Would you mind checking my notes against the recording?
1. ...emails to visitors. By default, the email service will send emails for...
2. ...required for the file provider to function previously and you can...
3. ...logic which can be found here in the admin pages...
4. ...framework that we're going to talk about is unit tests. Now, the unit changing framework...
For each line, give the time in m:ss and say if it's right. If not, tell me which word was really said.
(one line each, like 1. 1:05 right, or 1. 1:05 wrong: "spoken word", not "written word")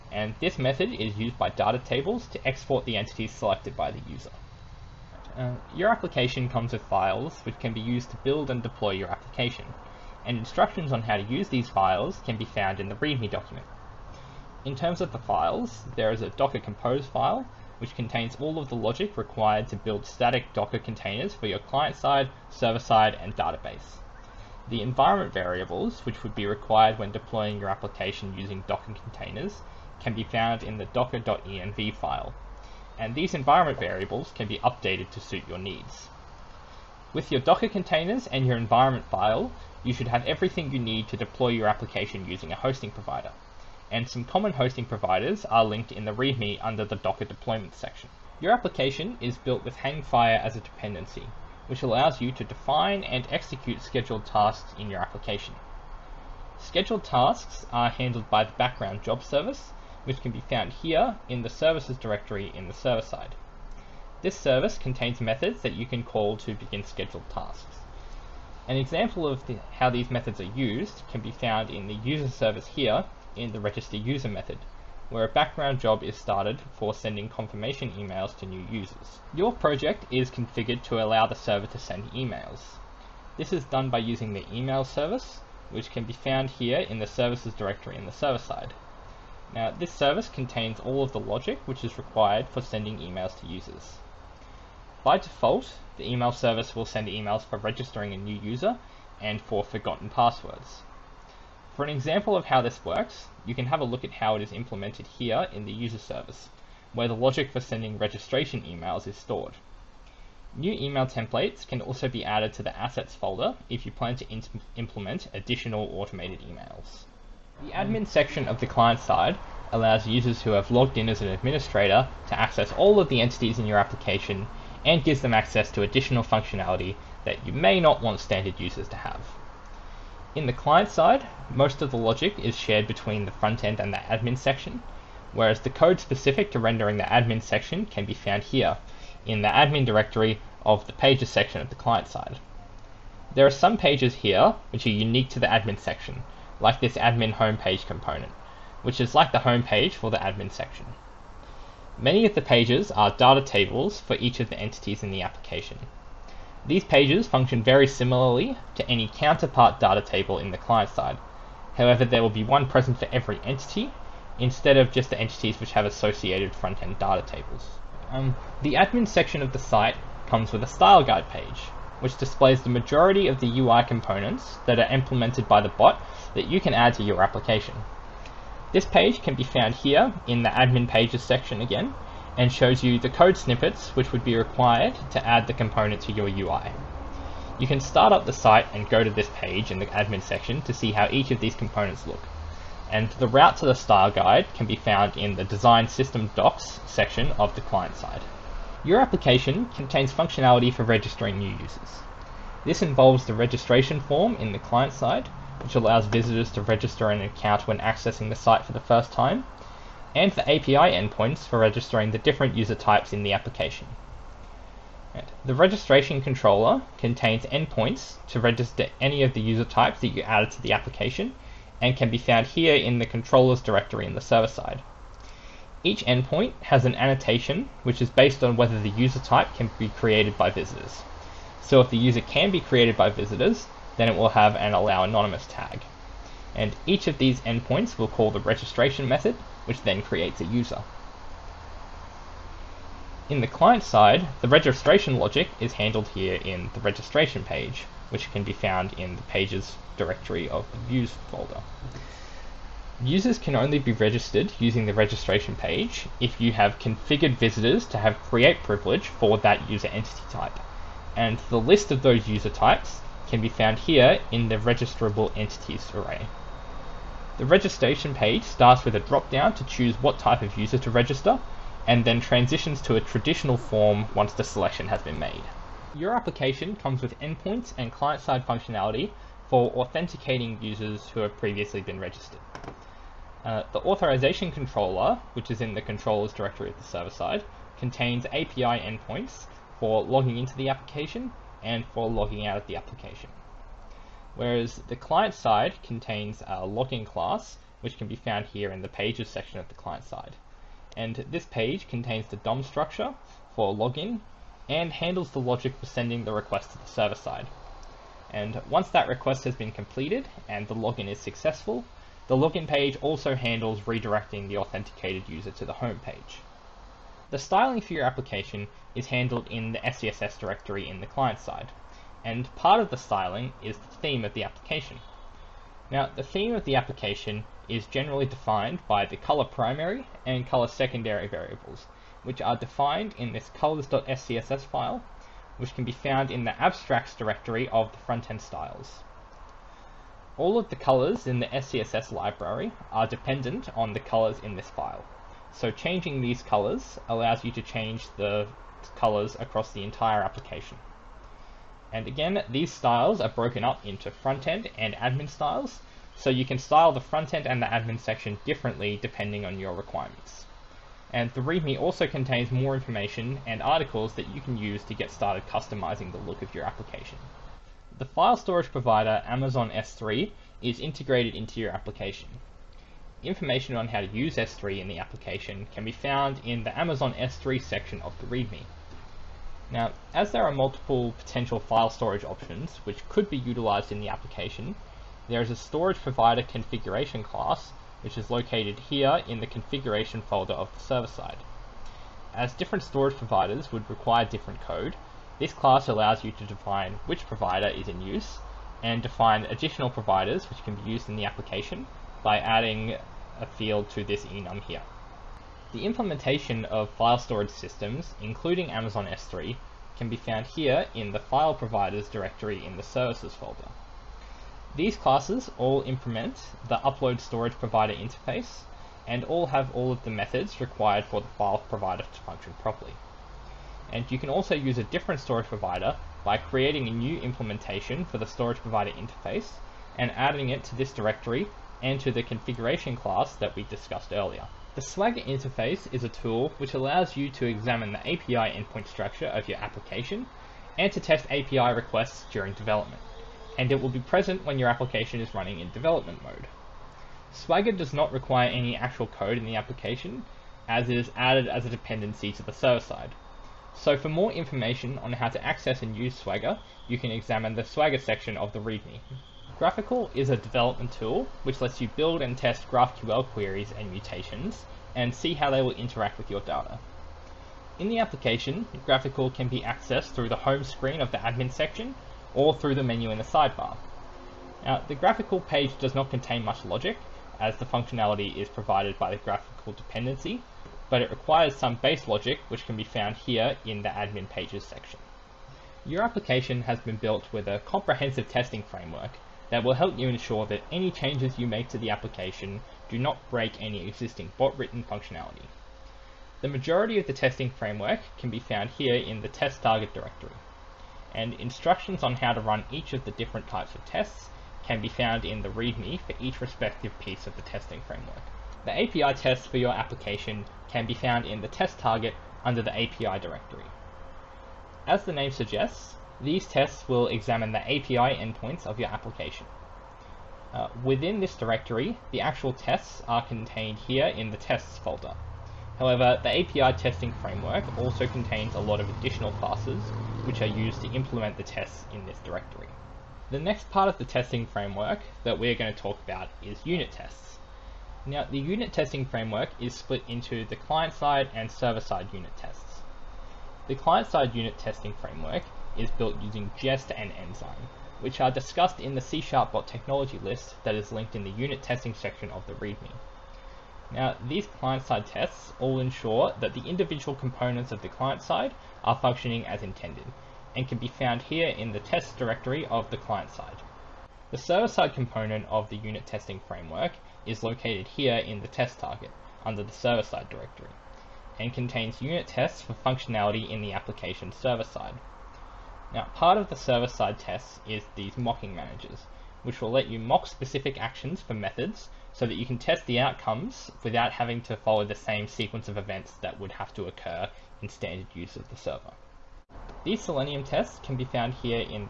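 1. 1:32 wrong: "users", not "visitors"
2. 7:00 wrong: "properly", not "previously"
3. 8:02 right
4. 8:54 wrong: "testing", not "changing".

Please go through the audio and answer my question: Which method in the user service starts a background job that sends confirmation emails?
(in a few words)
register user.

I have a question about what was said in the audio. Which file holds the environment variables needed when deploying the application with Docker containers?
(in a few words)
docker.env.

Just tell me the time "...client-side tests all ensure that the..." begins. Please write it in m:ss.
9:14.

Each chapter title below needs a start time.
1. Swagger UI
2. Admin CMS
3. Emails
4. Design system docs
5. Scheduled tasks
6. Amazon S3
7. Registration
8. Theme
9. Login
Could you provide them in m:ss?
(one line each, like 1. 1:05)
1. 6:46
2. 1:55
3. 1:18
4. 2:46
5. 0:47
6. 6:06
7. 3:16
8. 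5:15
9. 4:33.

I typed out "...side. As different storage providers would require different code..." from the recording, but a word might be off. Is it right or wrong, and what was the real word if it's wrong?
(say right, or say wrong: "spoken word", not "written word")
right.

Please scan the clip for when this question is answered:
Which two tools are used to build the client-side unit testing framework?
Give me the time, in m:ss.
9:06.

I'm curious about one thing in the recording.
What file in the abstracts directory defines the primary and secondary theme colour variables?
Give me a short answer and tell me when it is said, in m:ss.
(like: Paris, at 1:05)
colors.scss, at 5:33.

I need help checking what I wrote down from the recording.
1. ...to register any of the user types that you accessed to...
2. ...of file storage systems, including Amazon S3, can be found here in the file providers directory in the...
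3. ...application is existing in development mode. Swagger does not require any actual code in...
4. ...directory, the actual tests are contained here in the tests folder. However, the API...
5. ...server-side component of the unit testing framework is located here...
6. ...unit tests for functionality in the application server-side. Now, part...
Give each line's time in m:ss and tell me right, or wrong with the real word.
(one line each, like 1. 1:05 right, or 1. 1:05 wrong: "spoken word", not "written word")
1. 3:38 wrong: "added", not "accessed"
2. 6:46 right
3. 7:24 wrong: "running", not "existing"
4. 8:41 right
5. 9:24 right
6. 9:32 right.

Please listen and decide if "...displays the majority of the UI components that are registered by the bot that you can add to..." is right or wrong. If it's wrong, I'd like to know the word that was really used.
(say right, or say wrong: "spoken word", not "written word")
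wrong: "implemented", not "registered".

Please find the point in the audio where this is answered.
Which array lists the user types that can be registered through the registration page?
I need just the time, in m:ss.
4:24.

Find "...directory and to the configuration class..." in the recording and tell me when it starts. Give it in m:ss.
7:10.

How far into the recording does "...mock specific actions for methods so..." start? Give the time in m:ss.
9:39.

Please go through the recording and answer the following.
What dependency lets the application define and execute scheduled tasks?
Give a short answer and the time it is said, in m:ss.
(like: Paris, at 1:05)
Hangfire, at 0:49.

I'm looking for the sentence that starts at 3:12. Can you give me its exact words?
And the route to the style guide can be found in the design system docs section of the client side.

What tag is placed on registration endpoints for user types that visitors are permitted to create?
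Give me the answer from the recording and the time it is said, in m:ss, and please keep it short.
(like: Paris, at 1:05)
allow anonymous, at 3:54.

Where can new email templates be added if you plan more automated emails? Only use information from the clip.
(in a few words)
assets folder.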